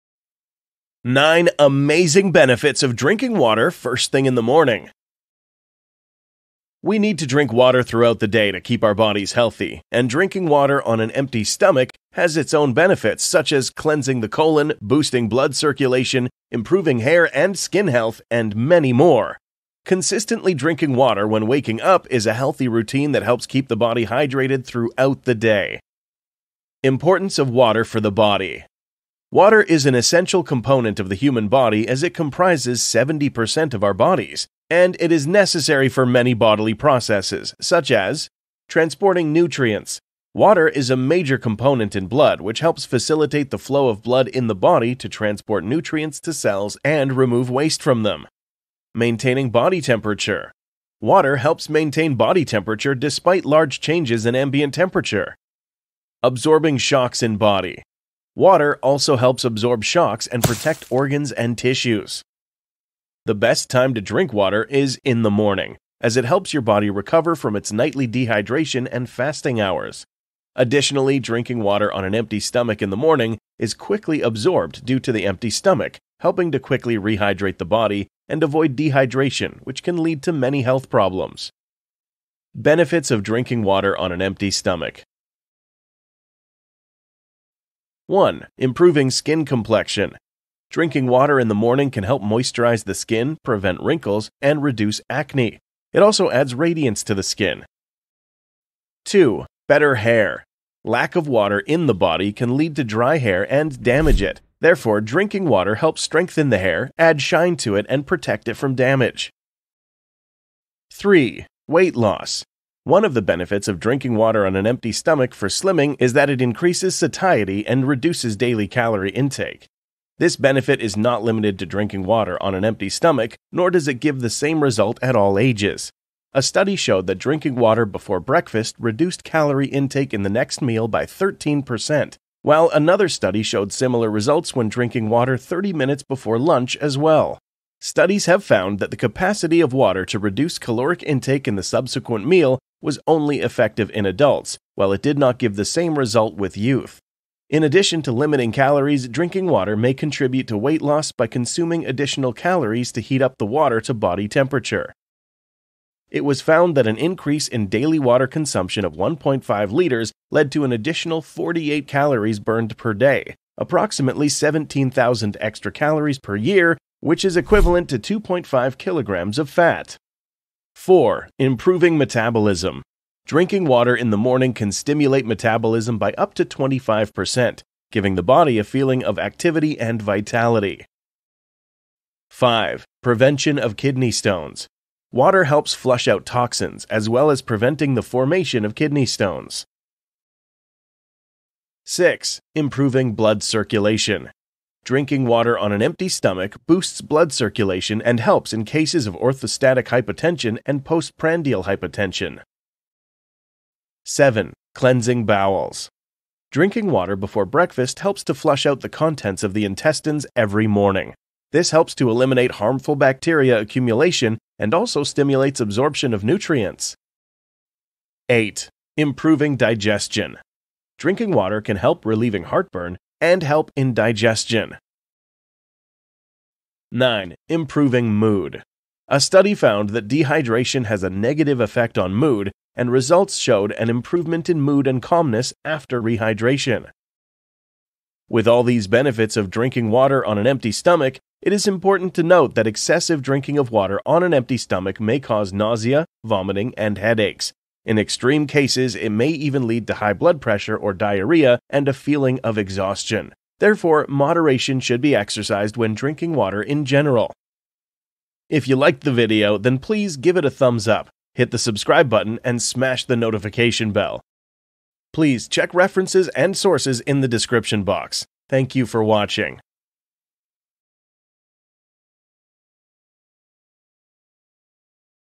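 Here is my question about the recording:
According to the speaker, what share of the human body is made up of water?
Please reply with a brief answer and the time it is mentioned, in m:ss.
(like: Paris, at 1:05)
70%, at 0:32.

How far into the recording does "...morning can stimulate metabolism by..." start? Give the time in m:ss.
2:54.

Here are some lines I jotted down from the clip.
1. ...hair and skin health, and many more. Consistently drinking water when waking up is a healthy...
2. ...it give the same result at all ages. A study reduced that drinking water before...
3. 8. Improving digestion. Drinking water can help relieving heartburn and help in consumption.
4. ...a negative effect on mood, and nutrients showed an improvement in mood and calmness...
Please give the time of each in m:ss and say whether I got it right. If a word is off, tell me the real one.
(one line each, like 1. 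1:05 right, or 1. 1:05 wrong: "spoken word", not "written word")
1. 0:16 right
2. 2:03 wrong: "showed", not "reduced"
3. 3:38 wrong: "digestion", not "consumption"
4. 3:51 wrong: "results", not "nutrients".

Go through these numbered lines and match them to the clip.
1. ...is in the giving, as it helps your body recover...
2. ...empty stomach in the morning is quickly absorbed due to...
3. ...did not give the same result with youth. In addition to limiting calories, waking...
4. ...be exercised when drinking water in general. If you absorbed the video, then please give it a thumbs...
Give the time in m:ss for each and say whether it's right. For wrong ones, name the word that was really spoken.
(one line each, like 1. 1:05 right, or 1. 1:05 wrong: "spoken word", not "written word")
1. 1:04 wrong: "morning", not "giving"
2. 1:12 right
3. 2:25 wrong: "drinking", not "waking"
4. 4:15 wrong: "liked", not "absorbed".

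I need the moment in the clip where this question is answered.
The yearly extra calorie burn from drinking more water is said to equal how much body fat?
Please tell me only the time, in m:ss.
2:47.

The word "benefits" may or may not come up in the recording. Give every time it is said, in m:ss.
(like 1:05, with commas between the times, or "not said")
0:02, 0:12, 1:22, 1:53, 2:00, 3:58.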